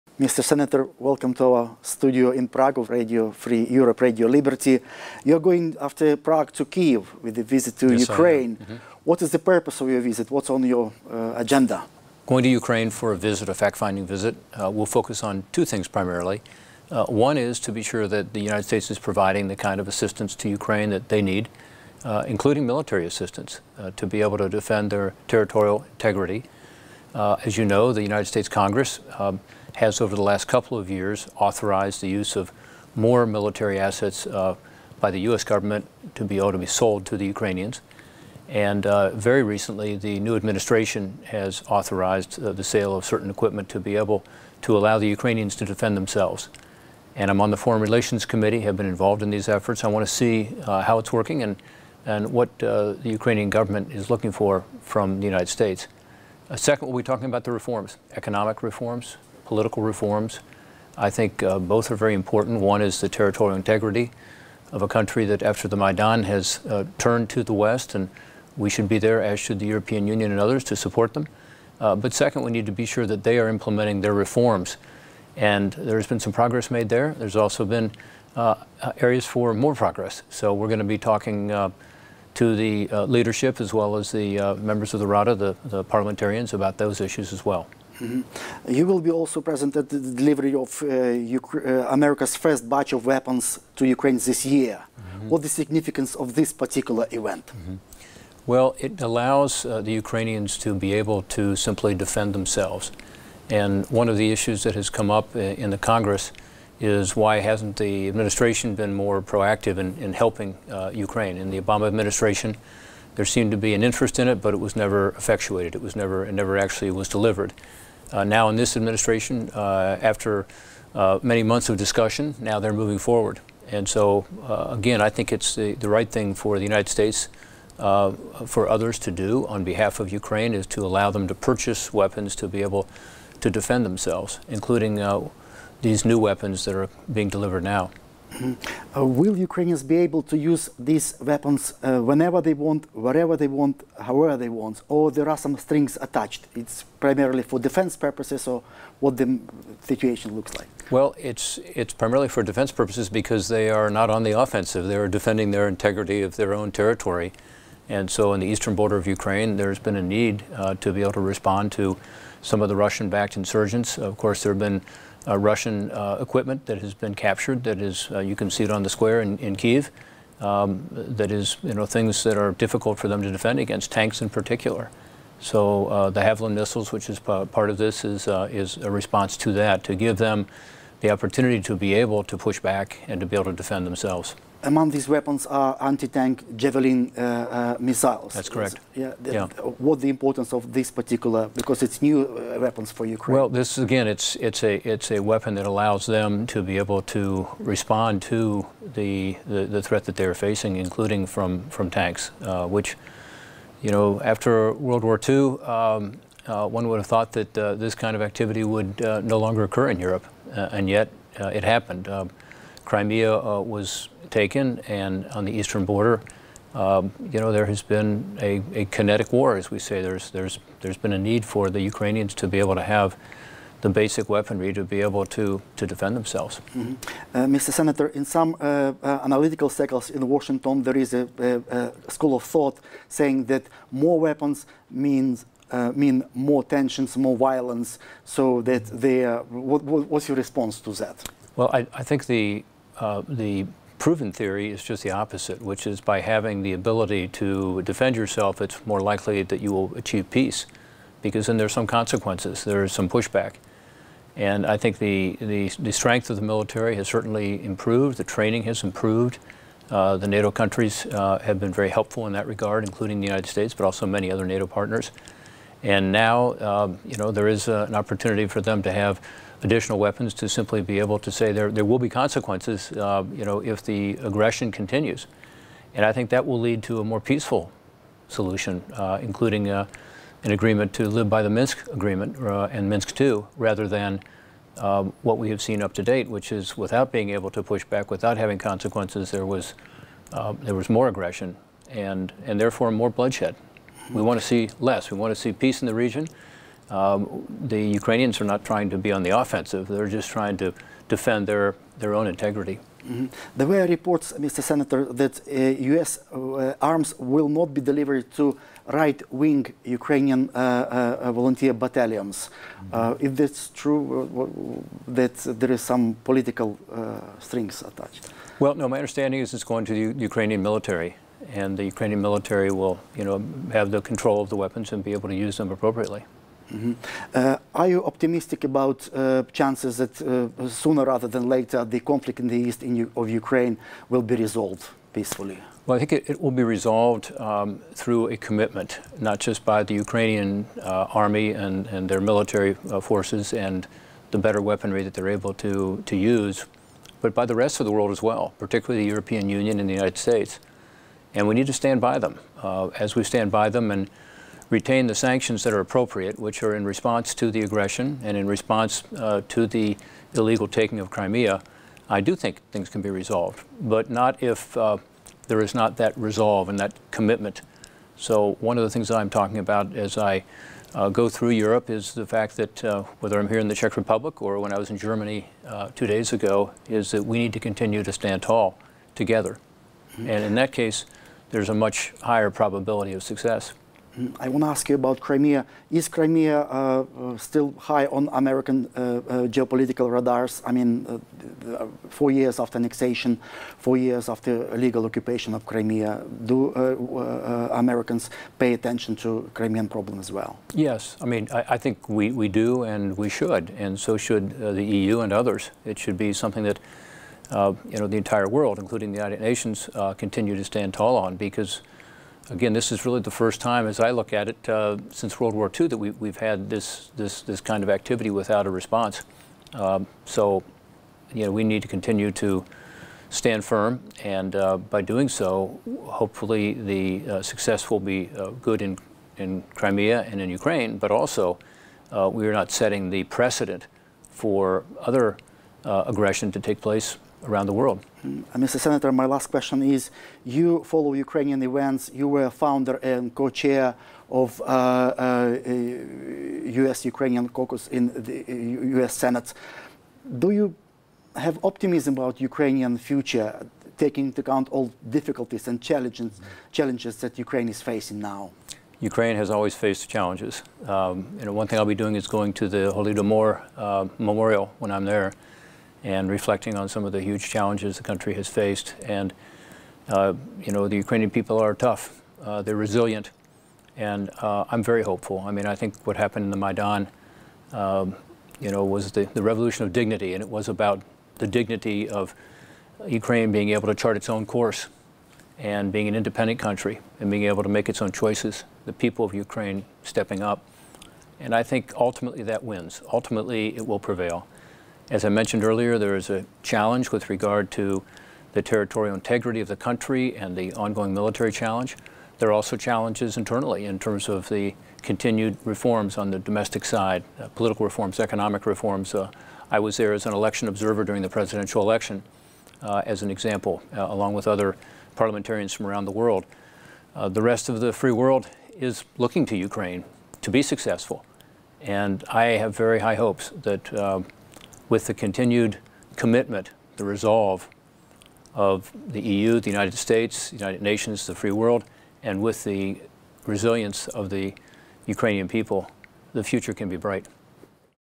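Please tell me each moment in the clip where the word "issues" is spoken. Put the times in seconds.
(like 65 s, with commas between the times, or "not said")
87 s, 104 s.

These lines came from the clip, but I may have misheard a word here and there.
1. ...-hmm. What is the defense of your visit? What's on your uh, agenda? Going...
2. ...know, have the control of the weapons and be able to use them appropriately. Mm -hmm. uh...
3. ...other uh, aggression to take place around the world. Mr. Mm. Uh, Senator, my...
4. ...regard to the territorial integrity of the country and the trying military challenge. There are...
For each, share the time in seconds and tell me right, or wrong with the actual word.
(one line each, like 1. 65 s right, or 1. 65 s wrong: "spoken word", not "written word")
1. 8 s wrong: "purpose", not "defense"
2. 323 s right
3. 434 s right
4. 497 s wrong: "ongoing", not "trying".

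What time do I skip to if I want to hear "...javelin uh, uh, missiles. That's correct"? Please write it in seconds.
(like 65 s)
186 s.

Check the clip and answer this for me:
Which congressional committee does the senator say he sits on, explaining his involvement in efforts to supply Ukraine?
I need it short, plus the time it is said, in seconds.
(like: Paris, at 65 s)
Foreign Relations Committee, at 47 s.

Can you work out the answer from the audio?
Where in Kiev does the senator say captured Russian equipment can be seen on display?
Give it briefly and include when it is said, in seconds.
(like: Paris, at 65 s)
the square, at 168 s.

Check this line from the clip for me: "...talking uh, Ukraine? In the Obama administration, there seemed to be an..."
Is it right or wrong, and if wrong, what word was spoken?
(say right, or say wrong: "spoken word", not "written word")
wrong: "helping", not "talking".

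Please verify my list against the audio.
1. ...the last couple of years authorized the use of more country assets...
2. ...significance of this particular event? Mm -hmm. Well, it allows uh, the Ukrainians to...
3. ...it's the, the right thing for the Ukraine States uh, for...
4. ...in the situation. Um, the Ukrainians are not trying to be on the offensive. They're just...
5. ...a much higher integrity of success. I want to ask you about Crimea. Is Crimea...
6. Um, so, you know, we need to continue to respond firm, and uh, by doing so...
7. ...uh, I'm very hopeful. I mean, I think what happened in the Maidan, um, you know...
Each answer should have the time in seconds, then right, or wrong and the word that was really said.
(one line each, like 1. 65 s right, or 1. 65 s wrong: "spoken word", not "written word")
1. 30 s wrong: "military", not "country"
2. 95 s right
3. 125 s wrong: "United", not "Ukraine"
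4. 295 s wrong: "region", not "situation"
5. 381 s wrong: "probability", not "integrity"
6. 419 s wrong: "stand", not "respond"
7. 474 s right.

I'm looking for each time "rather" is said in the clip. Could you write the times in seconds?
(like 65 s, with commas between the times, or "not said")
283 s, 331 s.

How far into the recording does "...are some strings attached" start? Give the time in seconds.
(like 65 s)
145 s.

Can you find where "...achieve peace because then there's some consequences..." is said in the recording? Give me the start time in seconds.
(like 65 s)
249 s.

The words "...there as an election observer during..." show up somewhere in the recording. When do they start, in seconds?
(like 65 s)
509 s.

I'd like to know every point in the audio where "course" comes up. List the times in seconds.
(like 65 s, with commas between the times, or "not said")
164 s, 484 s.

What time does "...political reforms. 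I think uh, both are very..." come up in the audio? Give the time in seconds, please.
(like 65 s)
59 s.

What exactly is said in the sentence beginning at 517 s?
Uh, the rest of the free world is looking to Ukraine to be successful.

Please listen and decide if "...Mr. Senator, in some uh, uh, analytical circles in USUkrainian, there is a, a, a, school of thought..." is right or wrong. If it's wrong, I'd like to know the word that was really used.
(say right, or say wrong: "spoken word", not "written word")
wrong: "Washington", not "USUkrainian".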